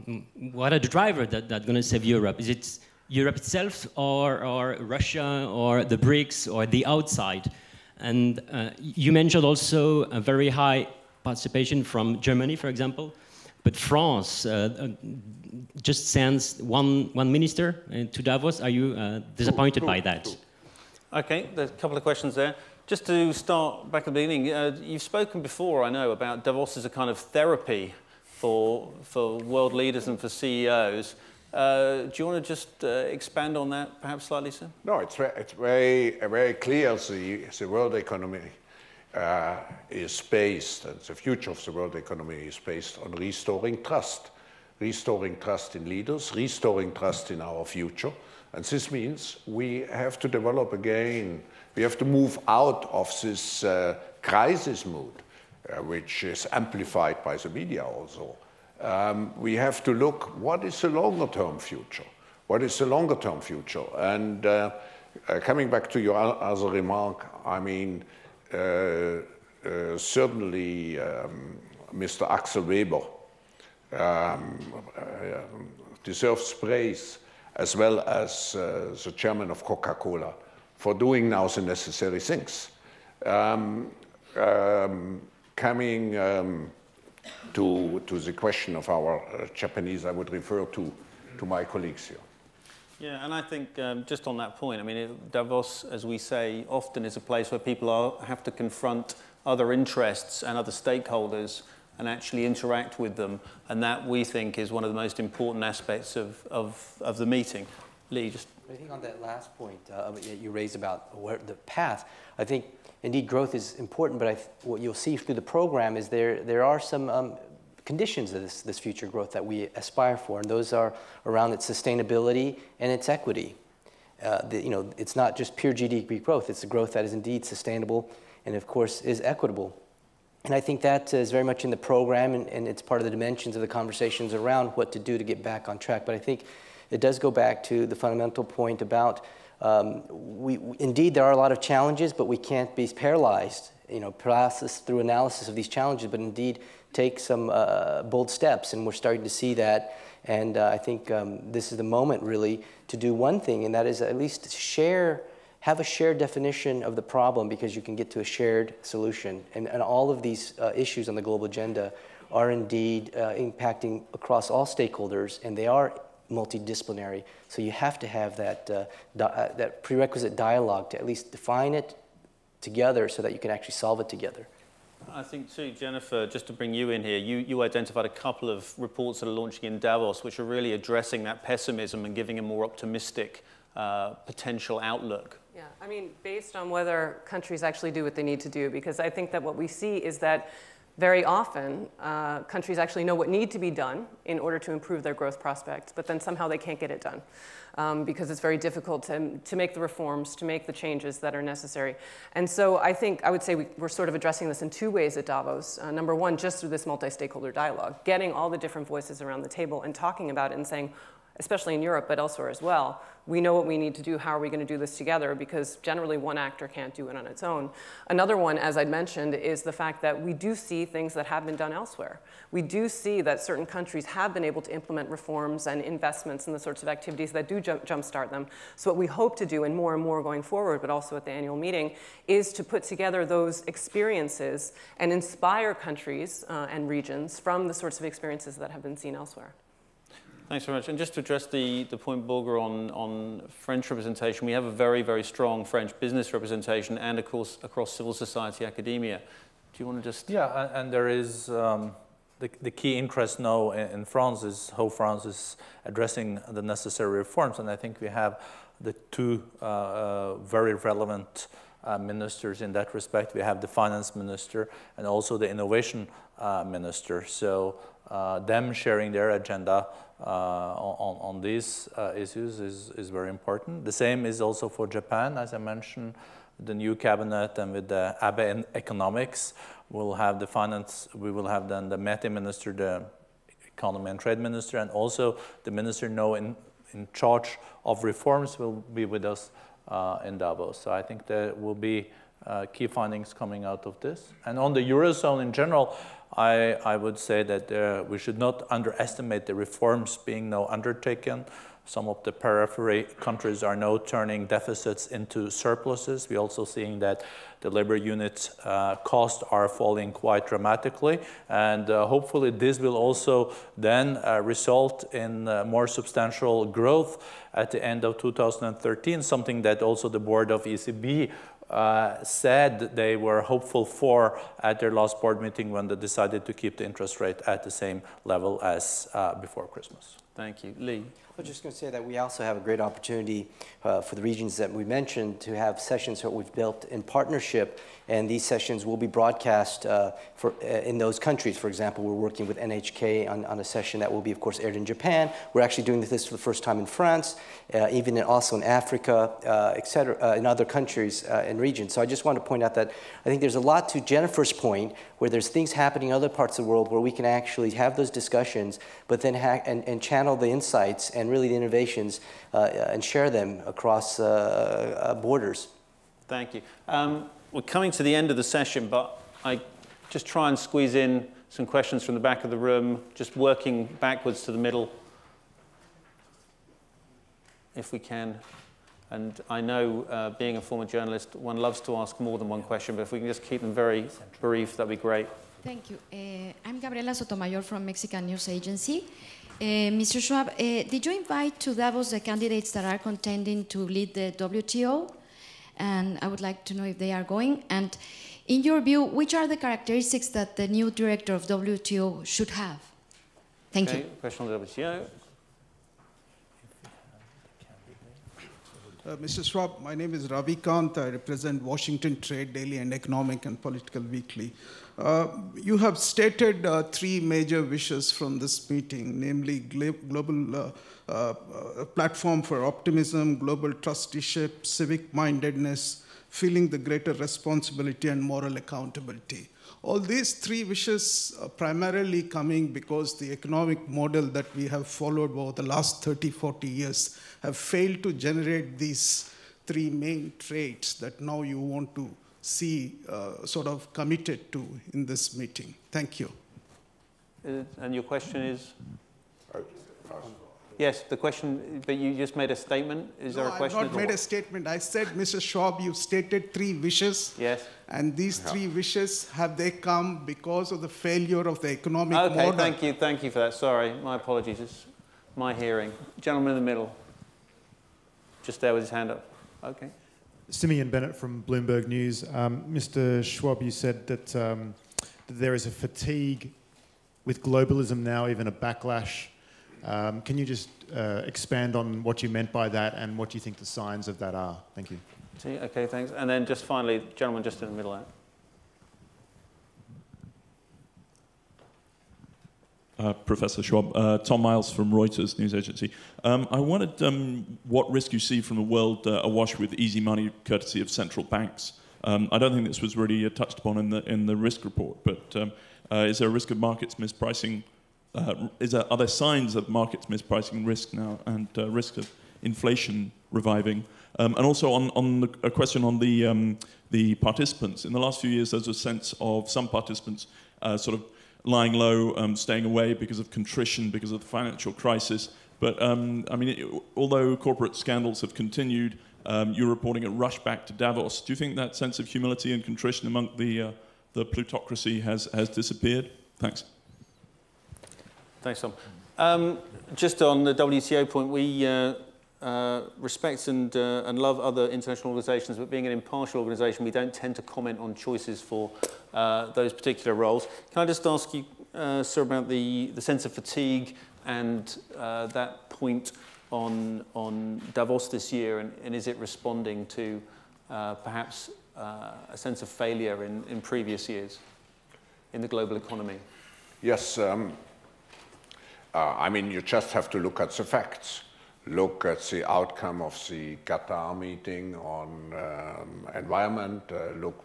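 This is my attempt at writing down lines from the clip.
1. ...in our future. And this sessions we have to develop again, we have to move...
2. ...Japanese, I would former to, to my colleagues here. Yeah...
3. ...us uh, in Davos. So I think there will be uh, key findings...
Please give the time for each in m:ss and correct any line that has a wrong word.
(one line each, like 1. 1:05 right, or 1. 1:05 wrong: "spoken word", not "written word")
1. 0:47 wrong: "means", not "sessions"
2. 1:29 wrong: "refer", not "former"
3. 4:49 right.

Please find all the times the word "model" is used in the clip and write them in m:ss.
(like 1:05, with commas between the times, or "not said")
7:13, 7:42.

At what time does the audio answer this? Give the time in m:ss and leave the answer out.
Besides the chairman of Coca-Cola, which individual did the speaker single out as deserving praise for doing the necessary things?
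1:12.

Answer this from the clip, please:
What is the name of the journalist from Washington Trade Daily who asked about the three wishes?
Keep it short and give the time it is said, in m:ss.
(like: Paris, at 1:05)
Ravi Kant, at 6:50.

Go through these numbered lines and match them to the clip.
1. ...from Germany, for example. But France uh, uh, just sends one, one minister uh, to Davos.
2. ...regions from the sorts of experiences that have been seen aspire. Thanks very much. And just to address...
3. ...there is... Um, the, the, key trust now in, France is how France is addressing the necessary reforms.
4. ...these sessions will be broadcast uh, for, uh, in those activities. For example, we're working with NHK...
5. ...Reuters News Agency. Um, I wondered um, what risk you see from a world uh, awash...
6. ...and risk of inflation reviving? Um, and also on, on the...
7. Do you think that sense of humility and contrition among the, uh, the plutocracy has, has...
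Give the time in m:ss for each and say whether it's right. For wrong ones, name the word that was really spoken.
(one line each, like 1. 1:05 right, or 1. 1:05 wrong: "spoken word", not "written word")
1. 0:11 right
2. 3:56 wrong: "elsewhere", not "aspire"
3. 4:10 wrong: "interest", not "trust"
4. 5:38 wrong: "countries", not "activities"
5. 8:14 right
6. 8:31 right
7. 8:51 right.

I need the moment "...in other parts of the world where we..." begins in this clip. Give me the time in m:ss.
5:56.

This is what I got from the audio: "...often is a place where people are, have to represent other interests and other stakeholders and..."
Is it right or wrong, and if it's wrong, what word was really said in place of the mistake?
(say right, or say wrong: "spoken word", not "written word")
wrong: "confront", not "represent".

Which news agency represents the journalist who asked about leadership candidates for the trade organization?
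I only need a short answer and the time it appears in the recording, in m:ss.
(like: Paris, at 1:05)
Mexican News Agency, at 6:27.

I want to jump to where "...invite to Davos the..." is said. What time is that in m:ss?
6:31.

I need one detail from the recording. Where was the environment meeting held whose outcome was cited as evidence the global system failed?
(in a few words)
Qatar.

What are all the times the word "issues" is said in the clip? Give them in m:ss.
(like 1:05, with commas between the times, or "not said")
2:40, 4:32.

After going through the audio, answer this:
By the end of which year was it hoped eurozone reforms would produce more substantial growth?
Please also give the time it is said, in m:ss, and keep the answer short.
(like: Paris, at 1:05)
2013, at 5:18.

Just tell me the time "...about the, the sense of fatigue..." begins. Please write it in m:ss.
9:12.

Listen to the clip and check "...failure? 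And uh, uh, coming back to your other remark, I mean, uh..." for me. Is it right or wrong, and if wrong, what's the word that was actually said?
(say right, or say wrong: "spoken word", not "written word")
wrong: "future", not "failure".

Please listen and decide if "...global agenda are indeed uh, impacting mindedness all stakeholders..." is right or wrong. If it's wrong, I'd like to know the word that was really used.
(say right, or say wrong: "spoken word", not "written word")
wrong: "across", not "mindedness".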